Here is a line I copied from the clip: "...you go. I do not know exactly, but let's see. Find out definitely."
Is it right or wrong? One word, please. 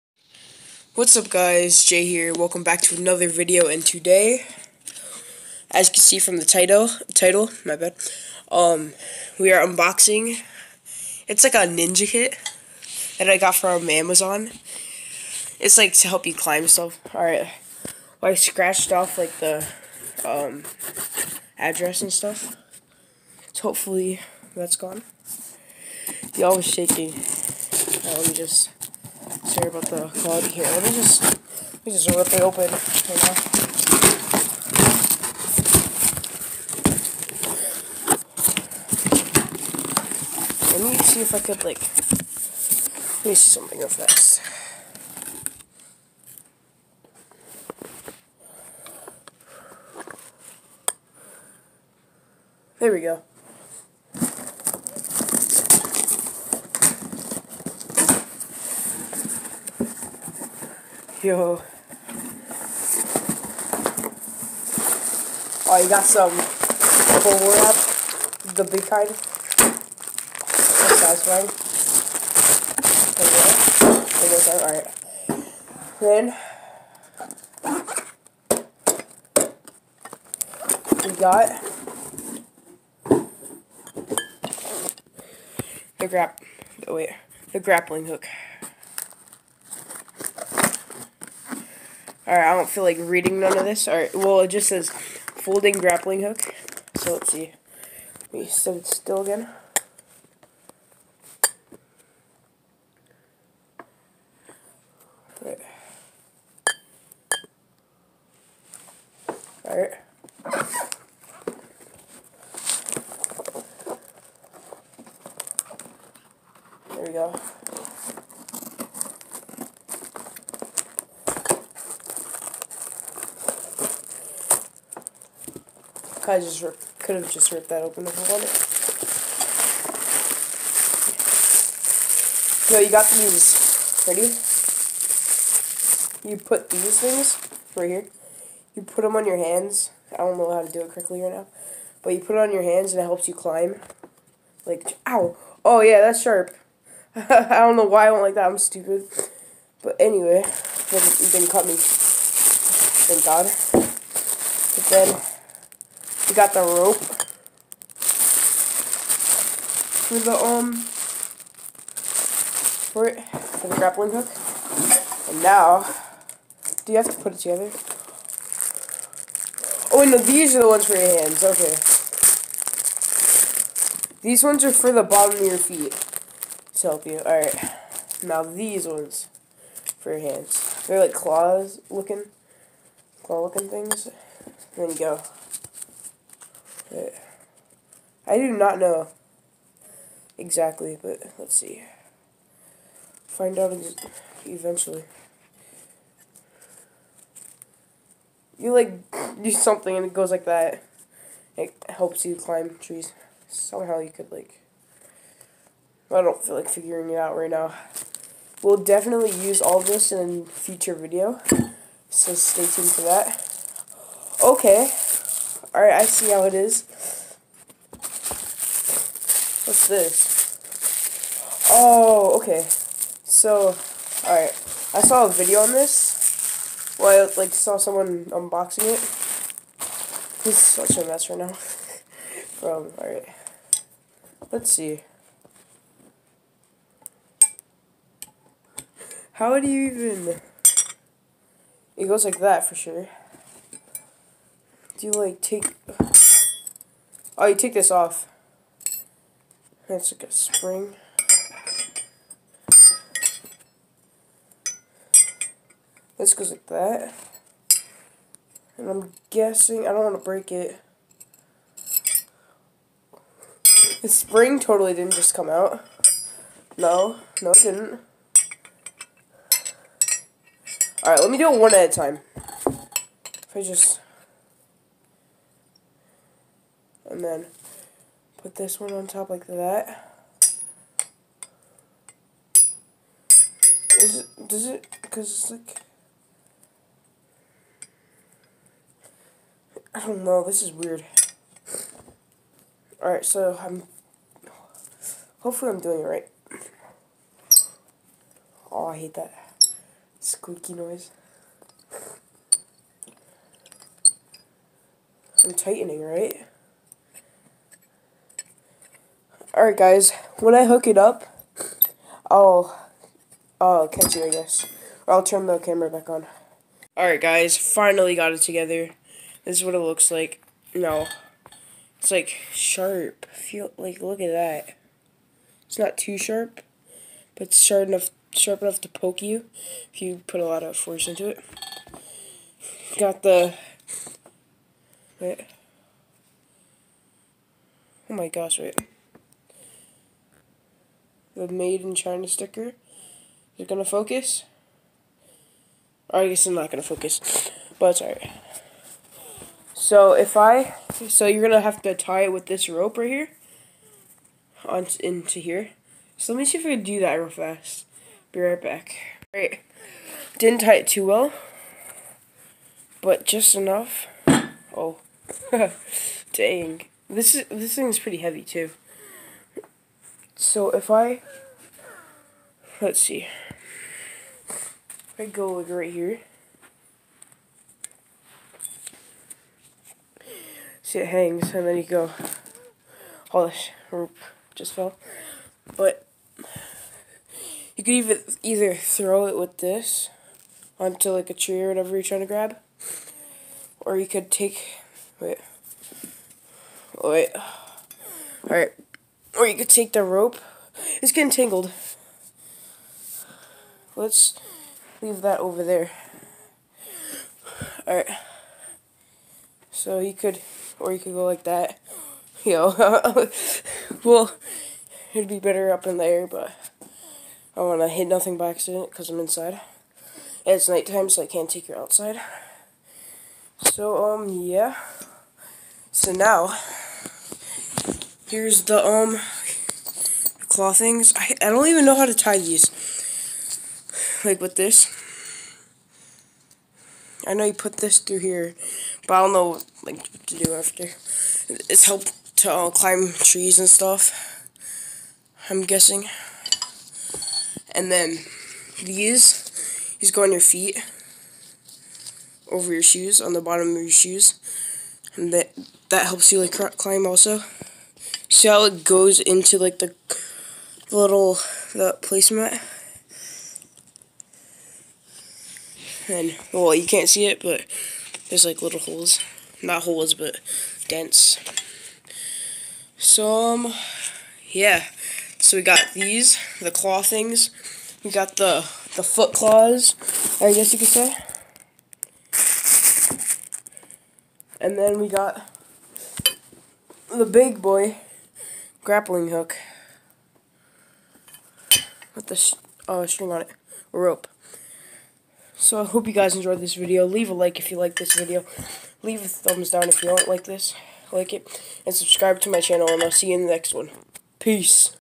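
wrong.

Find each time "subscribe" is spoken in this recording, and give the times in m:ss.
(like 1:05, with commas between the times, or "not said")
8:21.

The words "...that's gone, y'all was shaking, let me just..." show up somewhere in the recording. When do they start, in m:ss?
0:24.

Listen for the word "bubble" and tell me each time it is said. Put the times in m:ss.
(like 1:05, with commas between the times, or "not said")
1:07.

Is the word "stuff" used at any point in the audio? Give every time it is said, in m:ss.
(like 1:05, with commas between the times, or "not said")
0:16, 0:22, 7:23.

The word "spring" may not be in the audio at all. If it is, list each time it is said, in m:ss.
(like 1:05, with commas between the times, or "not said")
4:10, 4:24.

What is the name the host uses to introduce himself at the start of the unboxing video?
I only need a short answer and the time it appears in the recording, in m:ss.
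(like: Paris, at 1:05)
Jay, at 0:01.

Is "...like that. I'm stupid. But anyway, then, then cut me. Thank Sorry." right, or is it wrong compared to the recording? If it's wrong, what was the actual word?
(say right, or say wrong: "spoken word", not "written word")
wrong: "God", not "Sorry".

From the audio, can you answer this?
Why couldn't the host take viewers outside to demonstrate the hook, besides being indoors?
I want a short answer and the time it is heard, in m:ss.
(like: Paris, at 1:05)
nighttime, at 7:00.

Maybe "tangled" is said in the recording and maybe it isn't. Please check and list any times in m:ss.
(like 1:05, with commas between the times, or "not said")
6:41.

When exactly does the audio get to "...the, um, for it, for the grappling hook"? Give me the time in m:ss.
2:40.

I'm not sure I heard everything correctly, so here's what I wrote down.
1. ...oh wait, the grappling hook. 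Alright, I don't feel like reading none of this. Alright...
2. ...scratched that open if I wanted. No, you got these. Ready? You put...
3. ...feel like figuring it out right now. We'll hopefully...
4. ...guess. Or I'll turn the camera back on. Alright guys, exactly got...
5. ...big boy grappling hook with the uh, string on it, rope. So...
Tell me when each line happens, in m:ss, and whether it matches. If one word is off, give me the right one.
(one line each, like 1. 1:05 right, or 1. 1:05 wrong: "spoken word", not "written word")
1. 1:26 right
2. 2:07 wrong: "ripped", not "scratched"
3. 3:26 wrong: "definitely", not "hopefully"
4. 5:14 wrong: "finally", not "exactly"
5. 8:07 right.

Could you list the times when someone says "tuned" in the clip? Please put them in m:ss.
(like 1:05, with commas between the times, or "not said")
3:32.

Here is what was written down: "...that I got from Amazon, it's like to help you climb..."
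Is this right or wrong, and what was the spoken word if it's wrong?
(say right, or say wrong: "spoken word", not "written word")
right.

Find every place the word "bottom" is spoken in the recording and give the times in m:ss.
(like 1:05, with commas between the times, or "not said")
2:55, 7:33.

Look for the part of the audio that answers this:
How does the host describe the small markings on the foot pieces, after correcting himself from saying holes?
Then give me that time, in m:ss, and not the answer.
7:50.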